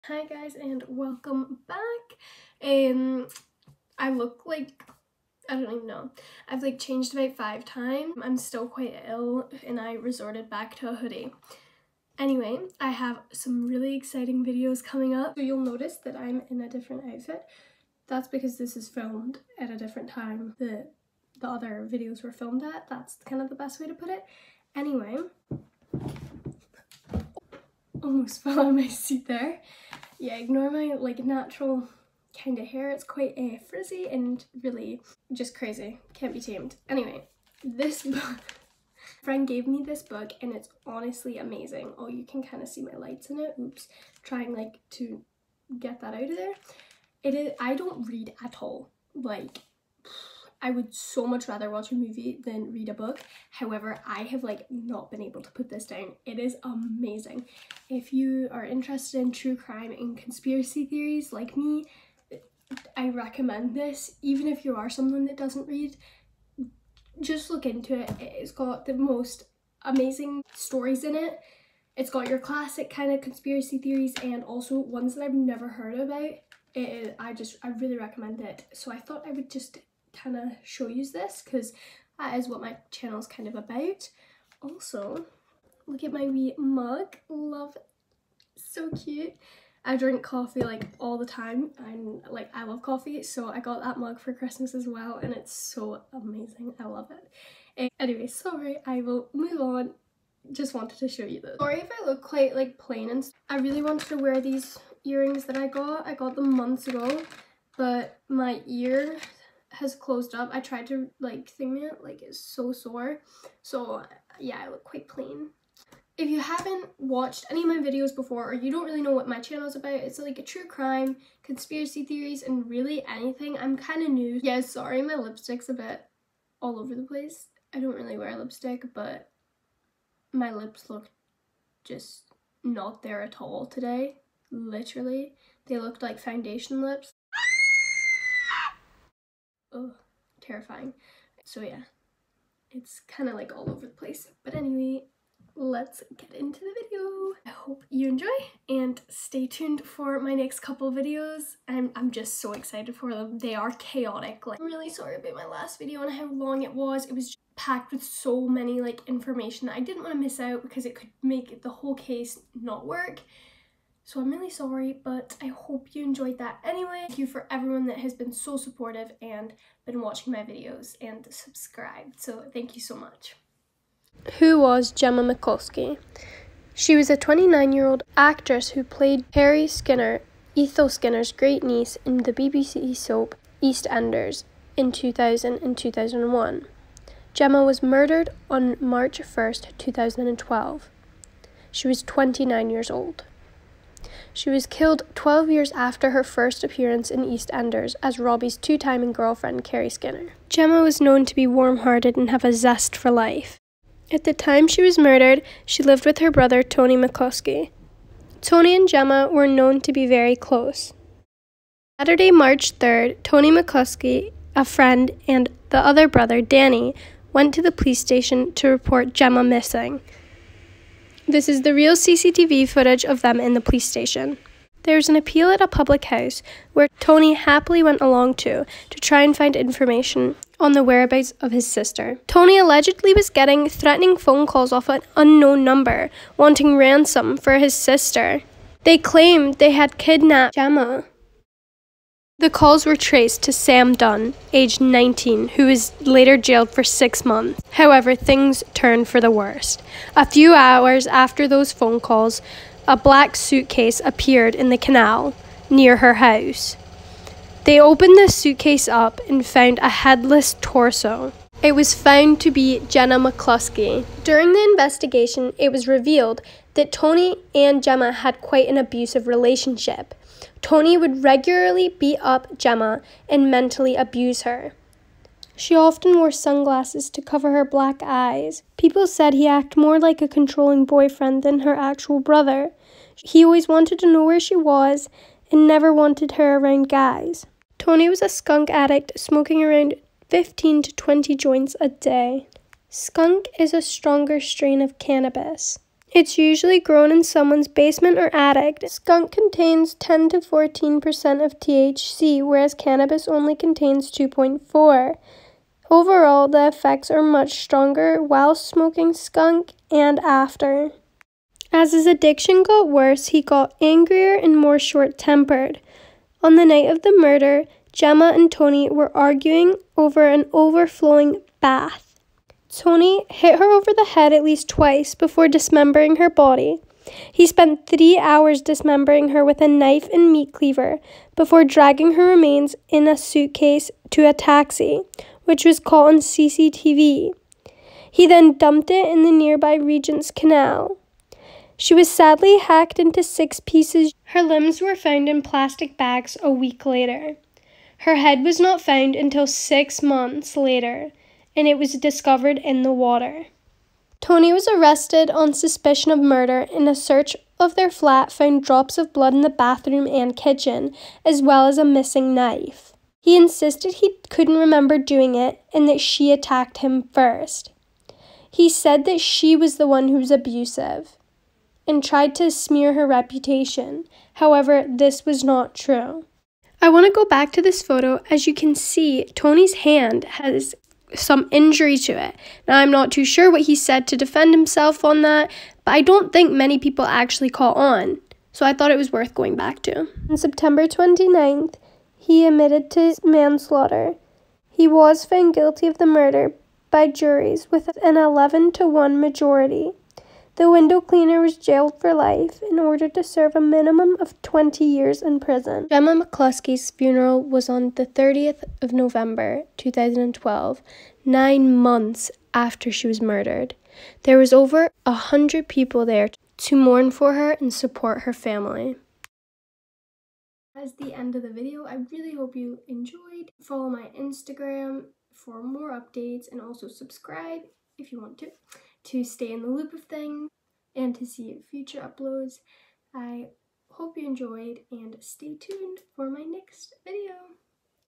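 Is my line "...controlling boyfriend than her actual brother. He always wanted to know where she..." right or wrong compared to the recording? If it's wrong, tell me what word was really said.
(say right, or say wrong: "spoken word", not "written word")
right.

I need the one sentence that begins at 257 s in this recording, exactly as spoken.
They opened the suitcase up and found a headless torso.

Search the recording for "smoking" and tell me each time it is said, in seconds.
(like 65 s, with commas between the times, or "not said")
289 s, 308 s.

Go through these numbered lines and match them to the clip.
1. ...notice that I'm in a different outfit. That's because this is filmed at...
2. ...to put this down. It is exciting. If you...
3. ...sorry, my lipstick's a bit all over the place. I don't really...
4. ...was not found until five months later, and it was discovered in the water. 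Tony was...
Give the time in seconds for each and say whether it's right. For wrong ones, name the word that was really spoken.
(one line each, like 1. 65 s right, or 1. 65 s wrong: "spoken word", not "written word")
1. 15 s right
2. 55 s wrong: "amazing", not "exciting"
3. 124 s right
4. 348 s wrong: "six", not "five".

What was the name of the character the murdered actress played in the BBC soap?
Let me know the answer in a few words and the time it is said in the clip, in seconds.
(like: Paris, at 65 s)
Harry Skinner, at 179 s.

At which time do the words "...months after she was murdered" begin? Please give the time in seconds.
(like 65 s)
411 s.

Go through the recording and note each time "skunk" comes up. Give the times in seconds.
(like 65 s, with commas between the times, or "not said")
288 s, 292 s, 298 s, 309 s.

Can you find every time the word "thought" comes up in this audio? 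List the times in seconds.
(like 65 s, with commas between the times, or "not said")
78 s, 388 s.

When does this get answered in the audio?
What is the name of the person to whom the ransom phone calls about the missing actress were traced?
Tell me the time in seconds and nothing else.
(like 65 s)
243 s.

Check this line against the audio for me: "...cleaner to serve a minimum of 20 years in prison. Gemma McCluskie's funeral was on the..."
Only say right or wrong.
wrong.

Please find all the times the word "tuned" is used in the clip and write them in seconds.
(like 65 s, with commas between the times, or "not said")
149 s, 435 s.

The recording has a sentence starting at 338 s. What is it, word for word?
He then dumped it in the nearby Regent's Canal.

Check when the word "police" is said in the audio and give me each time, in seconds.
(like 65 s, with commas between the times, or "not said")
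217 s, 223 s.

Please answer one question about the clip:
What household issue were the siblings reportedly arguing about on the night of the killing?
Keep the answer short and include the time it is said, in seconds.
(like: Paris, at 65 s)
an overflowing bath, at 320 s.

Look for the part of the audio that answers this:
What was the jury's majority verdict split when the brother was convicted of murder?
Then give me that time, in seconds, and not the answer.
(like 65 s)
398 s.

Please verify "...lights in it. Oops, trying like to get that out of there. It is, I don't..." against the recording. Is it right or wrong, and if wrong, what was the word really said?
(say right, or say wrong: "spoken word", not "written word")
right.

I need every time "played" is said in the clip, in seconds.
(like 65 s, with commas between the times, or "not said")
178 s.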